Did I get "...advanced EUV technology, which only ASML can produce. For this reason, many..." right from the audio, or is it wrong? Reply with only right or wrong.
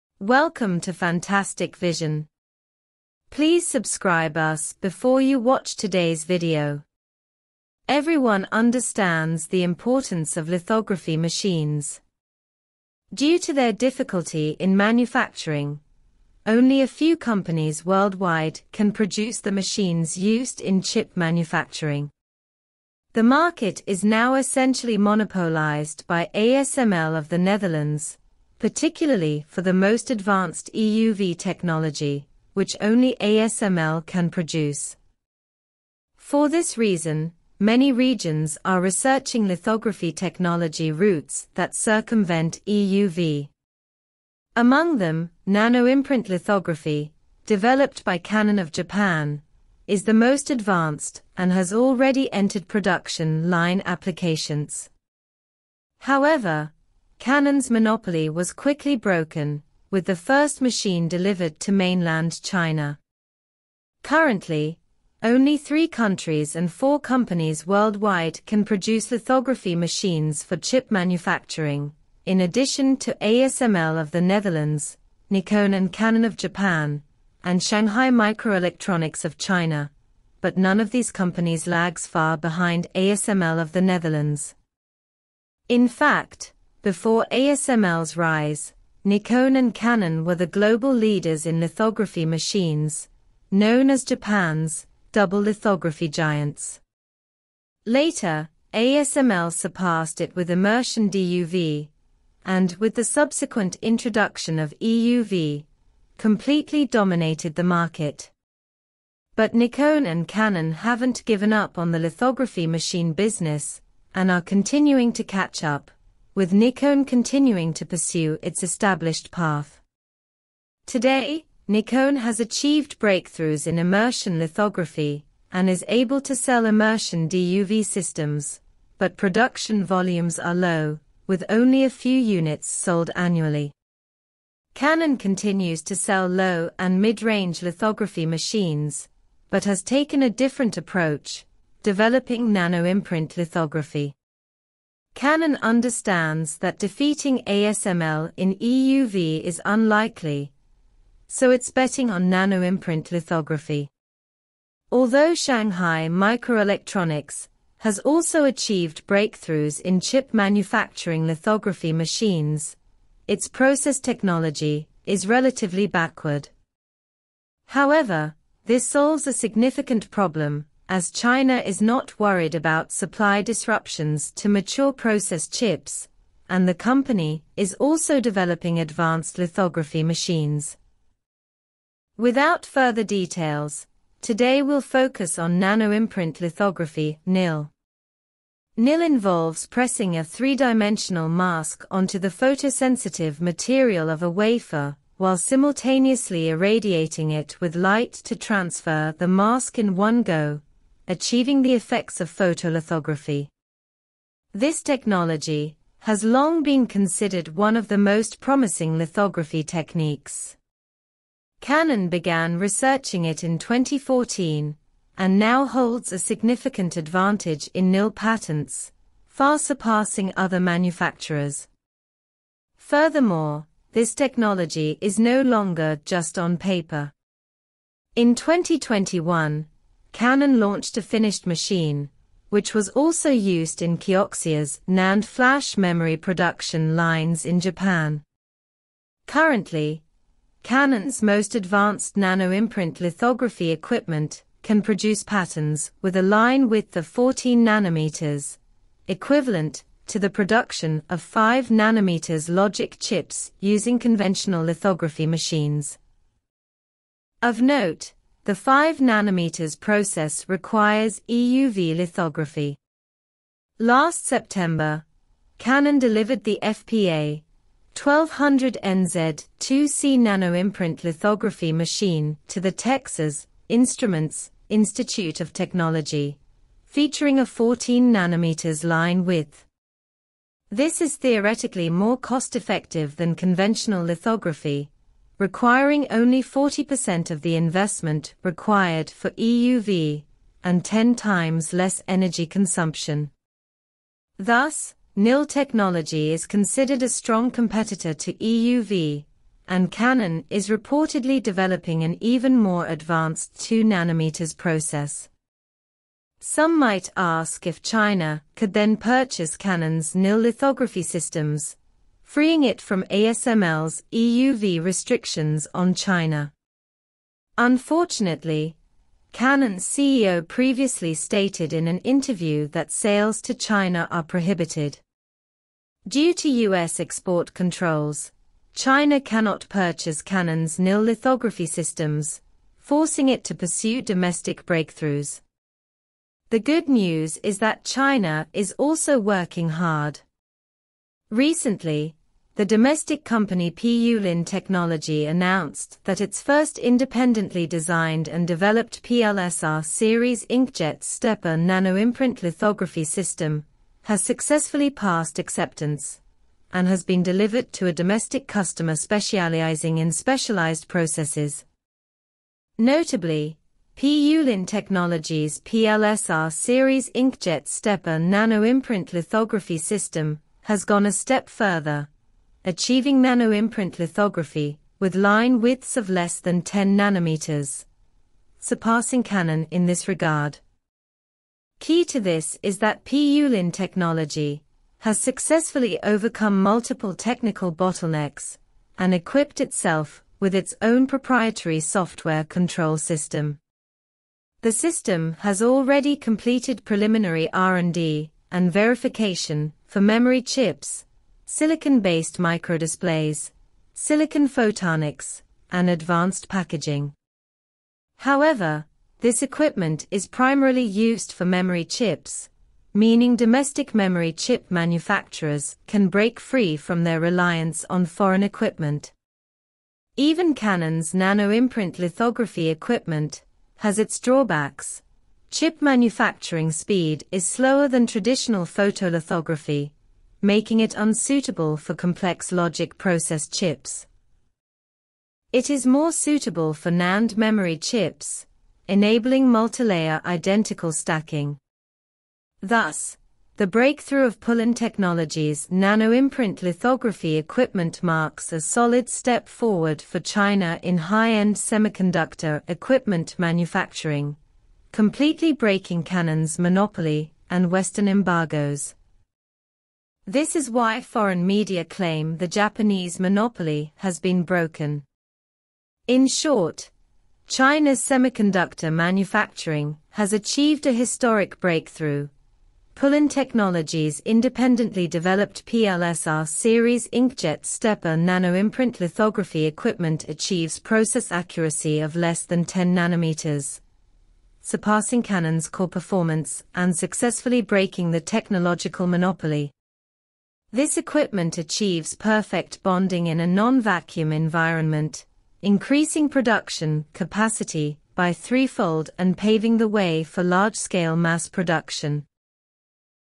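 right.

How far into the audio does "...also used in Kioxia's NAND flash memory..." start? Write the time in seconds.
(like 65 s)
232 s.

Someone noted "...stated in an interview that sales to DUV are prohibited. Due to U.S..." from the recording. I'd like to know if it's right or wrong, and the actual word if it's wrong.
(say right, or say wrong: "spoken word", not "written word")
wrong: "China", not "DUV".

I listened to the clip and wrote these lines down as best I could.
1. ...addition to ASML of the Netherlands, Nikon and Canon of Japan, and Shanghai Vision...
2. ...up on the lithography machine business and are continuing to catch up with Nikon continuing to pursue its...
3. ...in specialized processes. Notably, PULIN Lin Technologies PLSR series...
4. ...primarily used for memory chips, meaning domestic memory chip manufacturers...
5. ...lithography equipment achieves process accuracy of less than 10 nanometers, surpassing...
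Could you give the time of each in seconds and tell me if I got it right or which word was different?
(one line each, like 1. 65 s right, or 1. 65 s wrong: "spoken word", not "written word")
1. 72 s wrong: "Microelectronics", not "Vision"
2. 111 s right
3. 359 s right
4. 410 s right
5. 479 s right.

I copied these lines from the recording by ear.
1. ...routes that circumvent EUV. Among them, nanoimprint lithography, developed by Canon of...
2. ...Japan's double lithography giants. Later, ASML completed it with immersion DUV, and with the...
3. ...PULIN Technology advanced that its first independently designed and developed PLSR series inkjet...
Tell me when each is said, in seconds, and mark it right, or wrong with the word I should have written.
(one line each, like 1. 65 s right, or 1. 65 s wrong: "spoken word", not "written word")
1. 40 s right
2. 94 s wrong: "surpassed", not "completed"
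3. 343 s wrong: "announced", not "advanced".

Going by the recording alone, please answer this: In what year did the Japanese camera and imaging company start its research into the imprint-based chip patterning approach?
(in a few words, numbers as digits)
2014.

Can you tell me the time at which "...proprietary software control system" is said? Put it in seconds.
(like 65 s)
391 s.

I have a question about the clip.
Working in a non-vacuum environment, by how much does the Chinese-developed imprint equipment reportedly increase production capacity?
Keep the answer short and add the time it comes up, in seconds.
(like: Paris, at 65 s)
threefold, at 498 s.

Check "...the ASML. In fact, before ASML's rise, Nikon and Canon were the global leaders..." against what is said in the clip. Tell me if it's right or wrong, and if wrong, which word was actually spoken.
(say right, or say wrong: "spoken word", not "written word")
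wrong: "Netherlands", not "ASML".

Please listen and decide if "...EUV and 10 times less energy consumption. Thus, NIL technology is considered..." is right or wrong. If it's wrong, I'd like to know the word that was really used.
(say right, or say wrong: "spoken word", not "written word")
right.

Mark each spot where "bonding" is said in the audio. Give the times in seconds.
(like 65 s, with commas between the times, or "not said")
492 s.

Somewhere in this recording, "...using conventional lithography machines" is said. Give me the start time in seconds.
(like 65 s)
253 s.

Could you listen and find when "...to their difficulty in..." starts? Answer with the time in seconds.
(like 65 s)
13 s.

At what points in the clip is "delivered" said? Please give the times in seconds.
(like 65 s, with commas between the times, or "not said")
61 s, 265 s, 357 s.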